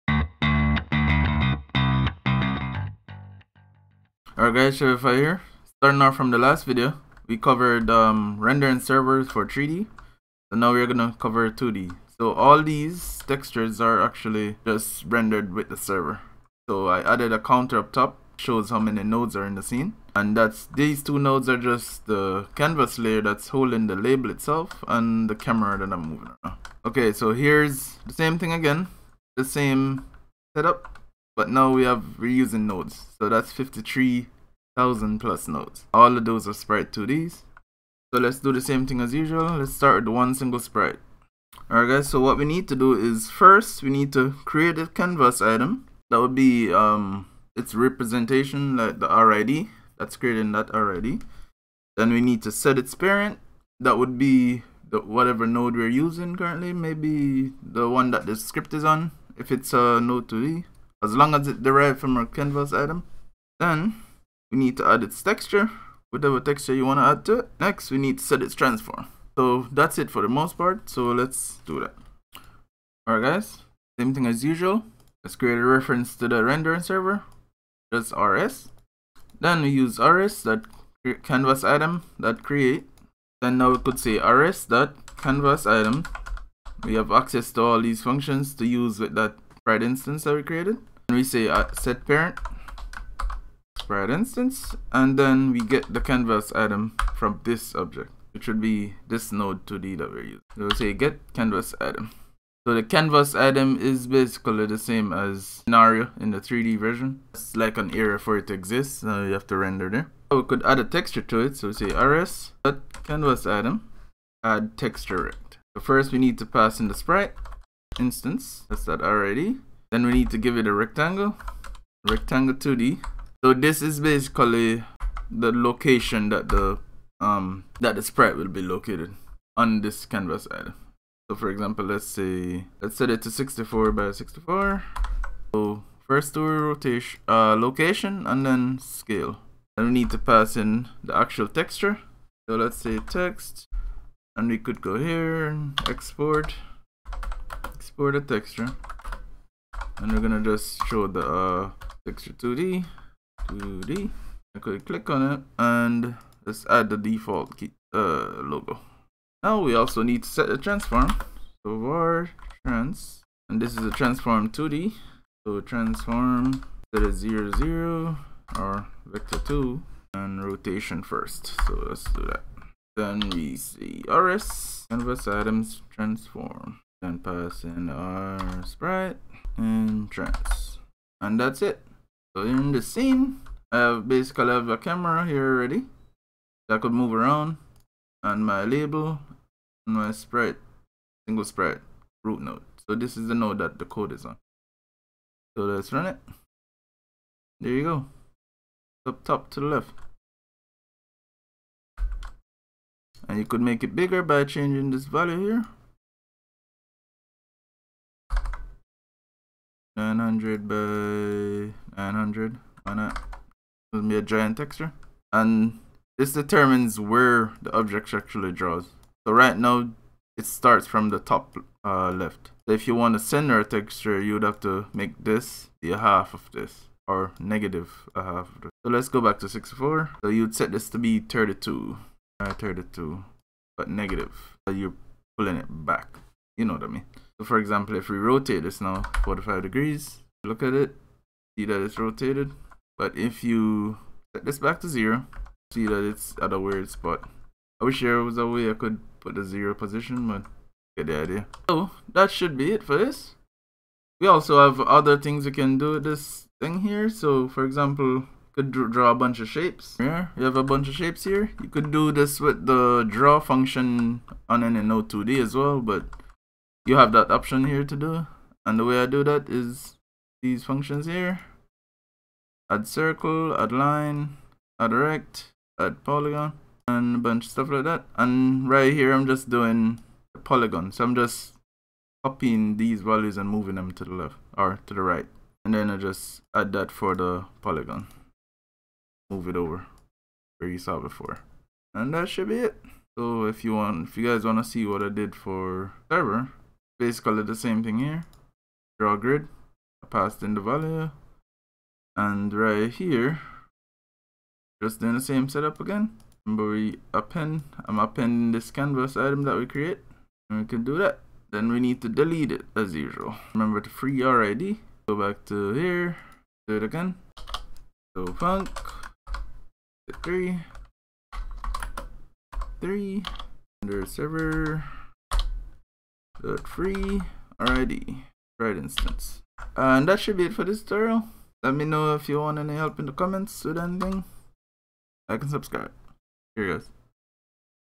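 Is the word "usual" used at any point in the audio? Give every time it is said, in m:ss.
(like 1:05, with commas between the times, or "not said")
0:39, 1:14, 5:12.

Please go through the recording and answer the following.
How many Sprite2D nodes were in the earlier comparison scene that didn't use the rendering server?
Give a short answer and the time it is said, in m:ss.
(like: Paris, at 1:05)
53,000, at 0:33.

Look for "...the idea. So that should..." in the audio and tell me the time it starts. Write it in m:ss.
4:11.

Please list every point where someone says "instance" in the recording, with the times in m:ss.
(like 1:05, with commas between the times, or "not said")
1:29, 1:34, 1:57, 5:28.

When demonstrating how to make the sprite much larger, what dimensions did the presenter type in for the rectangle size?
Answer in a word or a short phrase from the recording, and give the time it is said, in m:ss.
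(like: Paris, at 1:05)
900 by 900, at 3:30.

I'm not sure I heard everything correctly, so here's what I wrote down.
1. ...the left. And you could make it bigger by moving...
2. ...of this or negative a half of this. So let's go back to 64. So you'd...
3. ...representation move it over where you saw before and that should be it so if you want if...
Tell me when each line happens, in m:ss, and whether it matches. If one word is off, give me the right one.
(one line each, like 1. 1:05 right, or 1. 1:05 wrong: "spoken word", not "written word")
1. 3:19 wrong: "changing", not "moving"
2. 3:46 right
3. 4:47 wrong: "polygon", not "representation".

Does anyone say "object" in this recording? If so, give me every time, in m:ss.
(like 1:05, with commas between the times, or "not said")
1:37, 3:37.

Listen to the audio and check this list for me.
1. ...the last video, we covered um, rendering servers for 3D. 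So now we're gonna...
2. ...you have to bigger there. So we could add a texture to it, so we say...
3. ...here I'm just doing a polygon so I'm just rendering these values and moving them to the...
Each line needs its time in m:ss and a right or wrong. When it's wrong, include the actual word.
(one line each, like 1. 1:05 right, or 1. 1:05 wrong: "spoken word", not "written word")
1. 0:06 right
2. 1:49 wrong: "render", not "bigger"
3. 4:38 wrong: "copying", not "rendering".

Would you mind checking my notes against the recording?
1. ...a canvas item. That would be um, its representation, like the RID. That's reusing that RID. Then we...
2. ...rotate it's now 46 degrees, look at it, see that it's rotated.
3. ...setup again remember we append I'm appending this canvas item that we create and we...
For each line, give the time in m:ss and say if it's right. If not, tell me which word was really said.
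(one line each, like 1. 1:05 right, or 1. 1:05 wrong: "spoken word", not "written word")
1. 0:44 wrong: "creating", not "reusing"
2. 3:58 wrong: "45", not "46"
3. 5:05 right.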